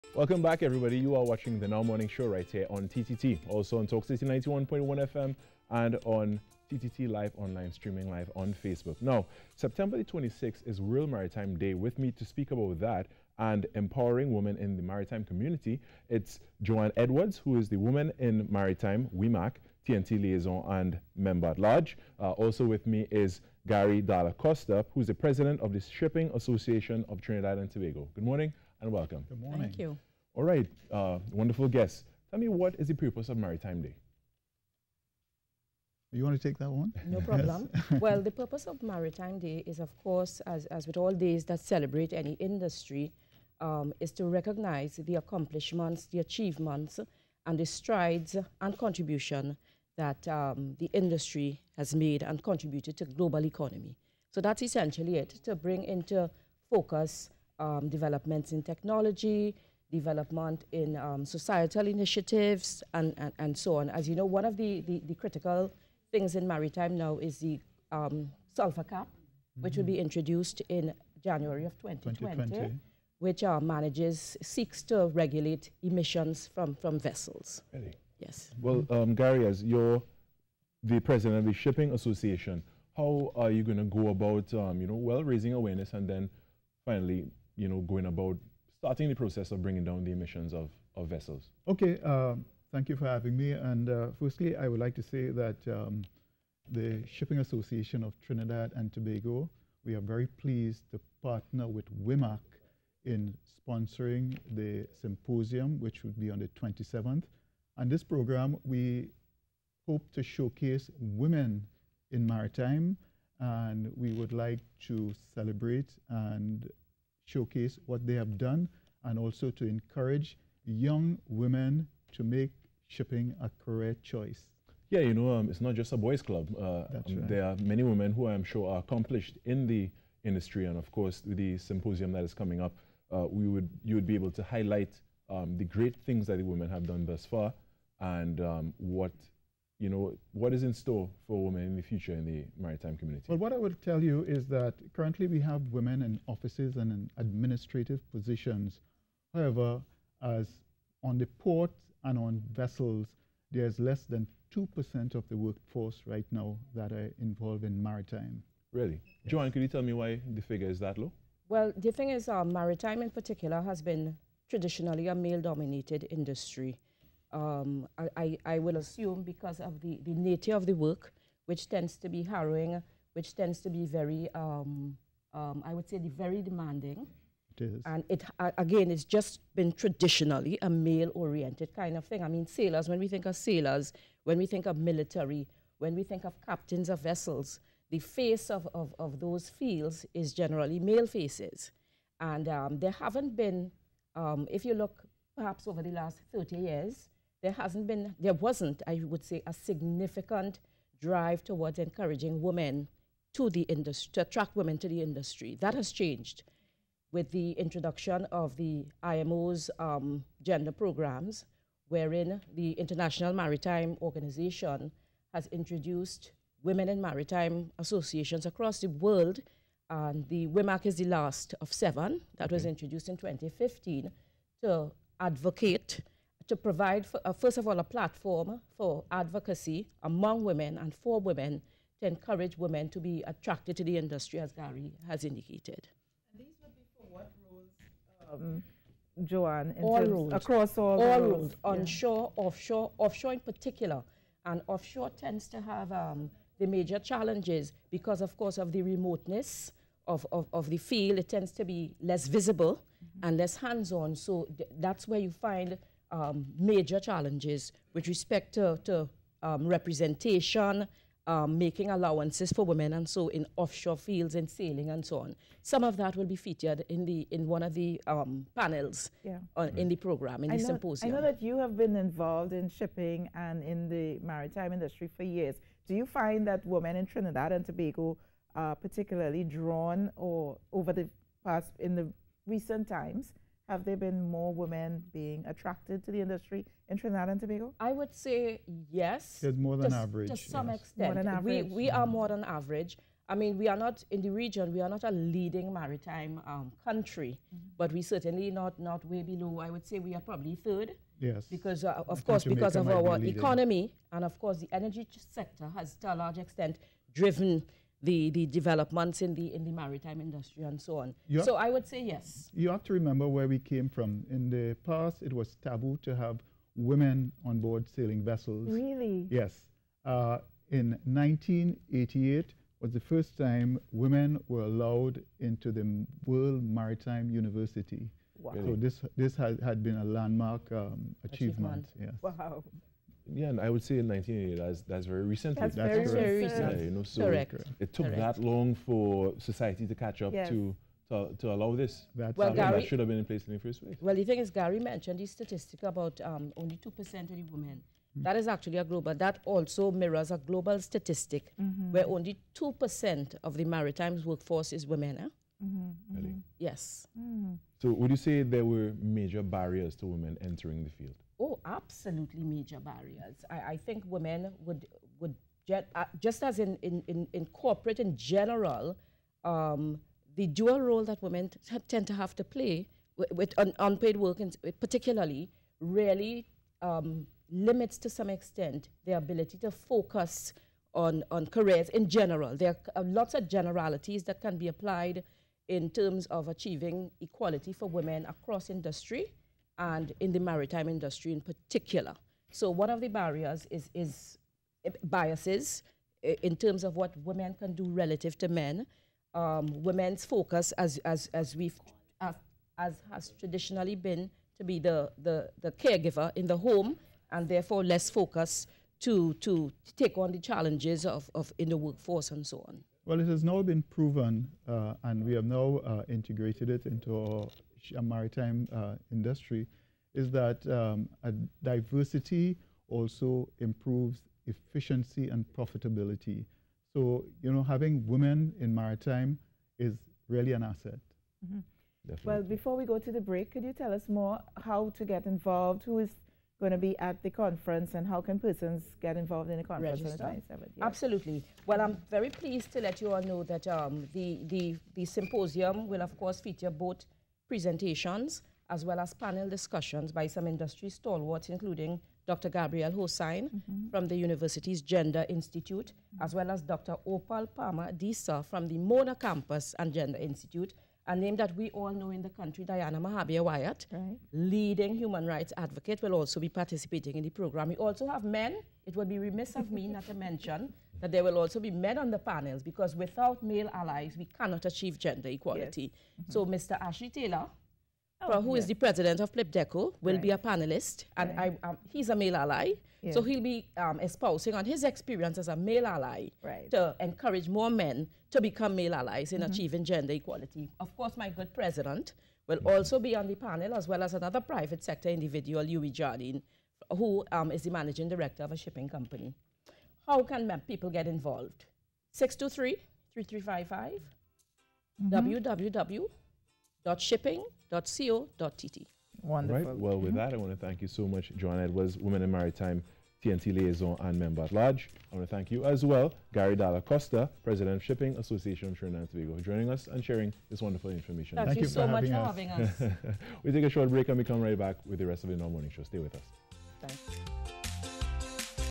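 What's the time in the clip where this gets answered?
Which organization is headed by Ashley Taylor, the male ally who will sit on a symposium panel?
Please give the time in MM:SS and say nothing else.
07:59.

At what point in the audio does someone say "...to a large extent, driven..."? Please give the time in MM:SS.
05:05.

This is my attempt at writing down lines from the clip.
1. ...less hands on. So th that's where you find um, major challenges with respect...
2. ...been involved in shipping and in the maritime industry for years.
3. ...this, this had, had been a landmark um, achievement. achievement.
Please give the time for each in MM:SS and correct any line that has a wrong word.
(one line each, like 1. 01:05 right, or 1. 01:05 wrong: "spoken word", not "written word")
1. 04:13 right
2. 04:31 right
3. 05:28 right.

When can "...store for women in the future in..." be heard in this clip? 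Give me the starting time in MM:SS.
02:20.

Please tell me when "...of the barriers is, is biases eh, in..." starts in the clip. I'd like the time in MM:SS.
06:32.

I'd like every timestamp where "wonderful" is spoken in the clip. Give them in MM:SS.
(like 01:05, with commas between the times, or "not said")
00:31, 08:29, 08:40.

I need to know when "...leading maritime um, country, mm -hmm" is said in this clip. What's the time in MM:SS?
04:55.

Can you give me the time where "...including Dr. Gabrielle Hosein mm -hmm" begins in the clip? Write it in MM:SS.
07:31.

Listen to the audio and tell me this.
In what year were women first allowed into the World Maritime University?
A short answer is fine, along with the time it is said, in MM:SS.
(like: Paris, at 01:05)
1988, at 05:21.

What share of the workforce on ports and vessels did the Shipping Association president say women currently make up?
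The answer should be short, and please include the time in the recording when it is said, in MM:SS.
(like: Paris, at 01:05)
less than 2%, at 02:33.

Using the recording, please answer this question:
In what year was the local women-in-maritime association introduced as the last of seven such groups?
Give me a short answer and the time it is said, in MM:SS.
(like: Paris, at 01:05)
2015, at 03:43.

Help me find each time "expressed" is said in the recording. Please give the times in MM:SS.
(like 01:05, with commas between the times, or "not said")
not said.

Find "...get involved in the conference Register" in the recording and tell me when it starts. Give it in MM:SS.
07:19.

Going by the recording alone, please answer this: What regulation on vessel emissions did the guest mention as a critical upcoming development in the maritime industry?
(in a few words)
sulfur cap.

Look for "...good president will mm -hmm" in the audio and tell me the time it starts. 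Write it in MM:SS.
08:11.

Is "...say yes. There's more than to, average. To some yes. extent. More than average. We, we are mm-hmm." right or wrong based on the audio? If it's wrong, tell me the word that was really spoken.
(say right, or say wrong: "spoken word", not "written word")
right.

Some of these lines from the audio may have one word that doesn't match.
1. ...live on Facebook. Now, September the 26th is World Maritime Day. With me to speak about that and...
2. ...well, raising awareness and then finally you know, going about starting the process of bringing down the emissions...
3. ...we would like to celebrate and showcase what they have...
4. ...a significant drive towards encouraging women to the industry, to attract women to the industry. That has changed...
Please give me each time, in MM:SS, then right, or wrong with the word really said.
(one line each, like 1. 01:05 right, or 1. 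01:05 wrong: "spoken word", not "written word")
1. 00:08 right
2. 01:25 right
3. 01:53 right
4. 03:19 right.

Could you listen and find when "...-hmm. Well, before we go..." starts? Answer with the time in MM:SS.
07:11.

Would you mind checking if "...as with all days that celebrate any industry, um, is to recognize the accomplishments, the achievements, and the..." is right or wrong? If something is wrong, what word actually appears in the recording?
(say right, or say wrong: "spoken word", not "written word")
right.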